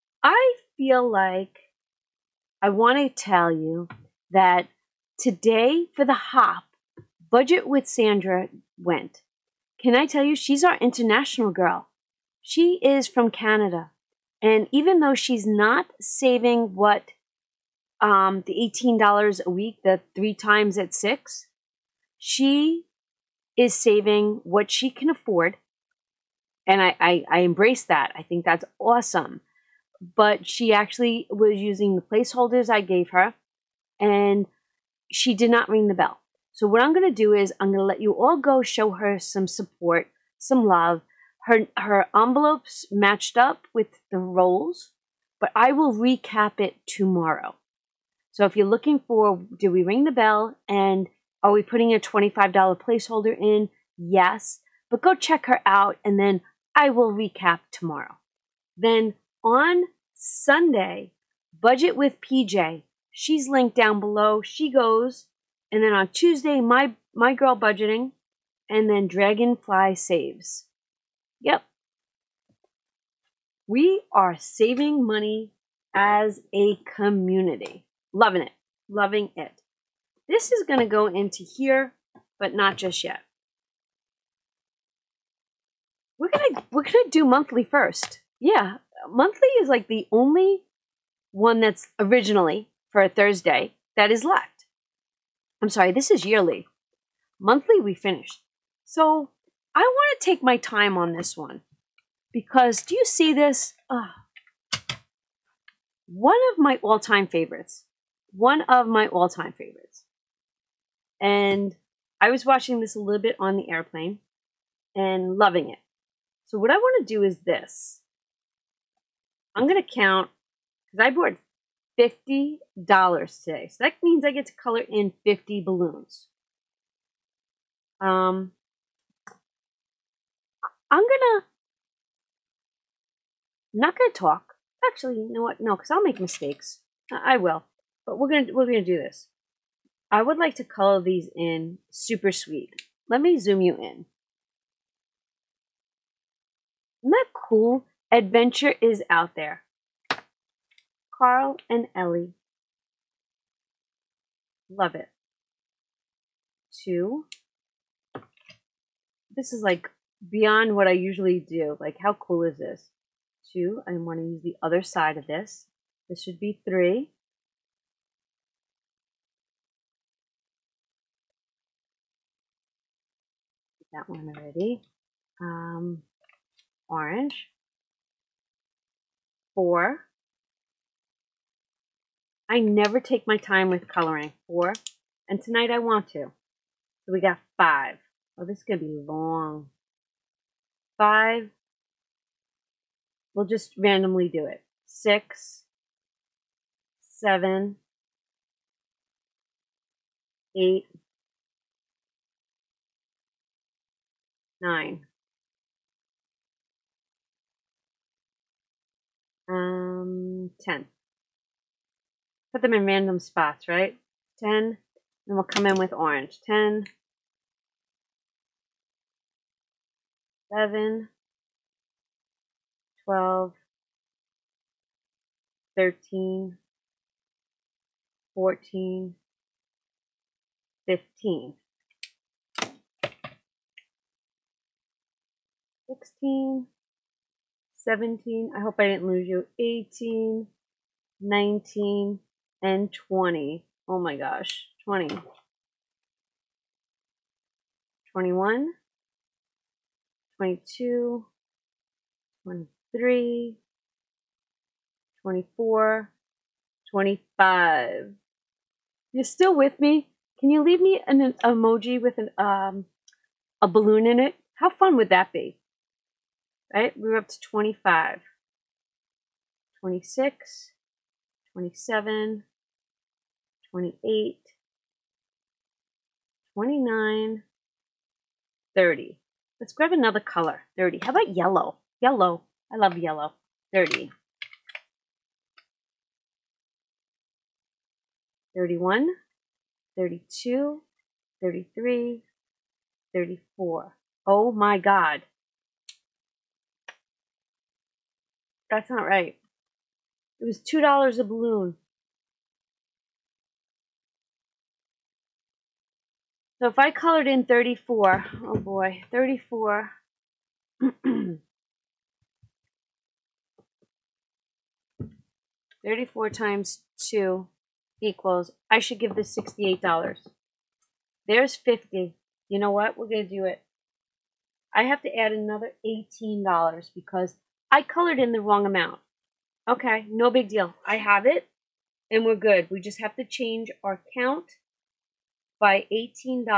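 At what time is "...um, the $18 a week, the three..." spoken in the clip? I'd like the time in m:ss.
0:18.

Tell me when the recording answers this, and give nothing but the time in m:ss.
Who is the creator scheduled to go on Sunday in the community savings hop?
1:01.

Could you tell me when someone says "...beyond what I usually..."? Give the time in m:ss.
2:40.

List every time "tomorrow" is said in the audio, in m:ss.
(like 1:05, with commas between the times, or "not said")
0:46, 0:57.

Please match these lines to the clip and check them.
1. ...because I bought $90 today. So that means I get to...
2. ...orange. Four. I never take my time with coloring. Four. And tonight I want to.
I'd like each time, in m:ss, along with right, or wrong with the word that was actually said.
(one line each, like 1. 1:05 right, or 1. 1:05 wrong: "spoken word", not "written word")
1. 2:00 wrong: "50", not "90"
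2. 2:56 right.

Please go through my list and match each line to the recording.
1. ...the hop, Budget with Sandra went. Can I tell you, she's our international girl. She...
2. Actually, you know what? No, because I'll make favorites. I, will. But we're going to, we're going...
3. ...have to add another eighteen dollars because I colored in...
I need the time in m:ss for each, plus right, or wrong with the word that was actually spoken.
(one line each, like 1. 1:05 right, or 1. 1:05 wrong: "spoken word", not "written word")
1. 0:06 right
2. 2:14 wrong: "mistakes", not "favorites"
3. 5:24 right.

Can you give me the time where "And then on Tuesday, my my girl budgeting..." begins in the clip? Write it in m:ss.
1:05.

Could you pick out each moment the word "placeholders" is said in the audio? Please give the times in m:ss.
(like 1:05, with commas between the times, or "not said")
0:32, 0:52.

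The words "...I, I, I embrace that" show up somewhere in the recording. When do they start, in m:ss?
0:26.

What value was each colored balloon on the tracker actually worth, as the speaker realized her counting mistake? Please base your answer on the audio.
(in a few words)
$2.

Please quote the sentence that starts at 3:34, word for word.
10, and we'll come in with orange.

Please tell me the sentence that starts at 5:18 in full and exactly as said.
I should give this sixty-eight dollars.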